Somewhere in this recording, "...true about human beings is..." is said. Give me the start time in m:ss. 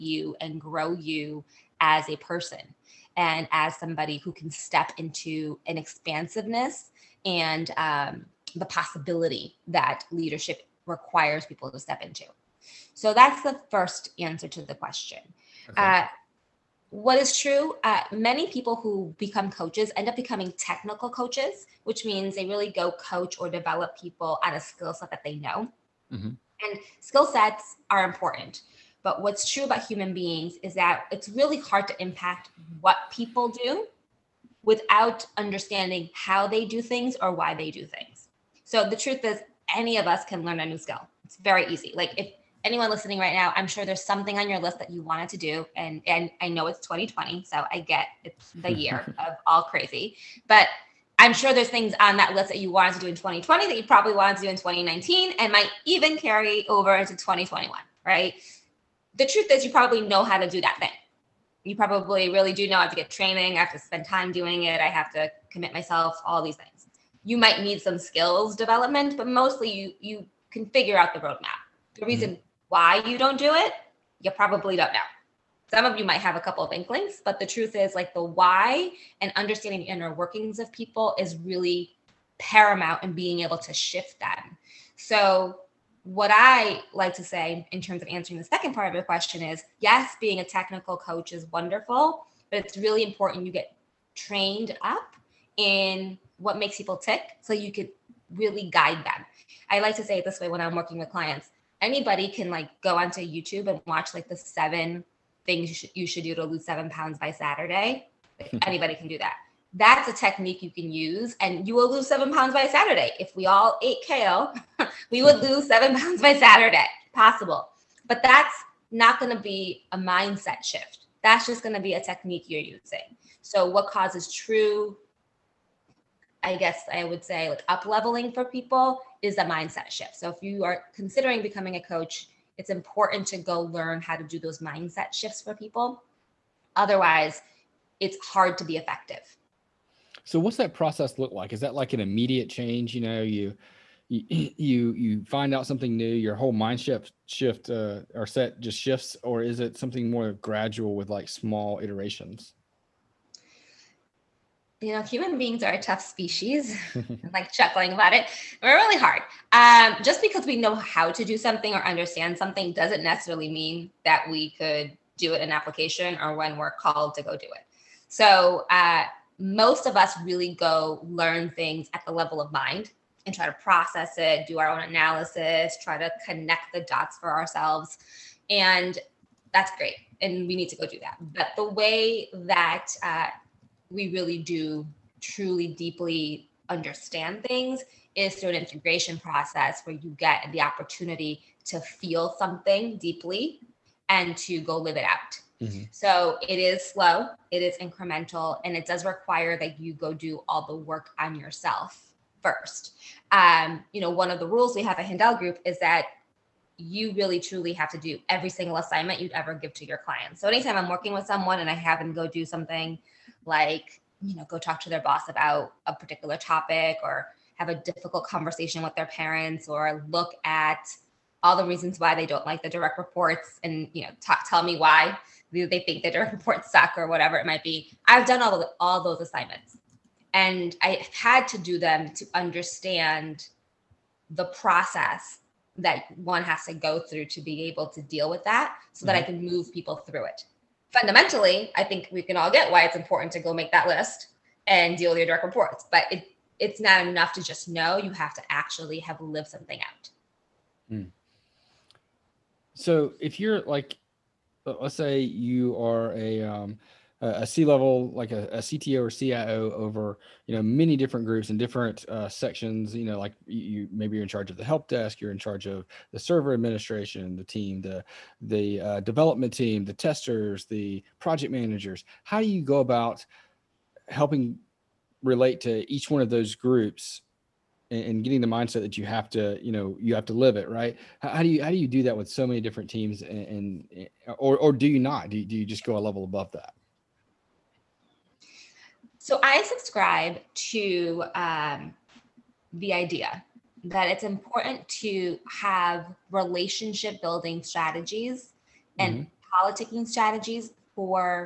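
0:29.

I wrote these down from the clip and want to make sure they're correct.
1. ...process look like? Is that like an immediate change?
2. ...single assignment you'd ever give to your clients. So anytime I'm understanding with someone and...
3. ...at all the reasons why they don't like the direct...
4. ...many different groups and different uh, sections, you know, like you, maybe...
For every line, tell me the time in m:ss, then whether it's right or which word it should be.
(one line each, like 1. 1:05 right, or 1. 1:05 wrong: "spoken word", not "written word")
1. 2:20 right
2. 3:28 wrong: "working", not "understanding"
3. 3:40 right
4. 4:20 right.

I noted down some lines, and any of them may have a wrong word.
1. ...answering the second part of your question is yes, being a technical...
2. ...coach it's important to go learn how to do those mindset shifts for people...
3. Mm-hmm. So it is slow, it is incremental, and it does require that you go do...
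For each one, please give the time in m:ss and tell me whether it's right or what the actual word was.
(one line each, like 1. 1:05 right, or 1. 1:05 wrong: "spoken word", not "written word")
1. 1:28 right
2. 2:11 right
3. 3:15 right.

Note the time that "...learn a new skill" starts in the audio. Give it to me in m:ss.
0:40.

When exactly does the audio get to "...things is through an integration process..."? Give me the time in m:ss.
3:07.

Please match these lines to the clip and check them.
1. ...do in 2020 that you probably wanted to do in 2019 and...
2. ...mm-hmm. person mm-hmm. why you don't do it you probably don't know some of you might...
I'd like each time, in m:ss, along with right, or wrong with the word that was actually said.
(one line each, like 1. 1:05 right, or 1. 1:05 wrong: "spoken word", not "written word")
1. 0:52 right
2. 1:12 wrong: "reason", not "person".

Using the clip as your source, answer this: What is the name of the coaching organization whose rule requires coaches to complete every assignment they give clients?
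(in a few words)
Handel Group.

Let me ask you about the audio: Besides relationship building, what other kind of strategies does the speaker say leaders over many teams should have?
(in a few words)
Politicking strategies.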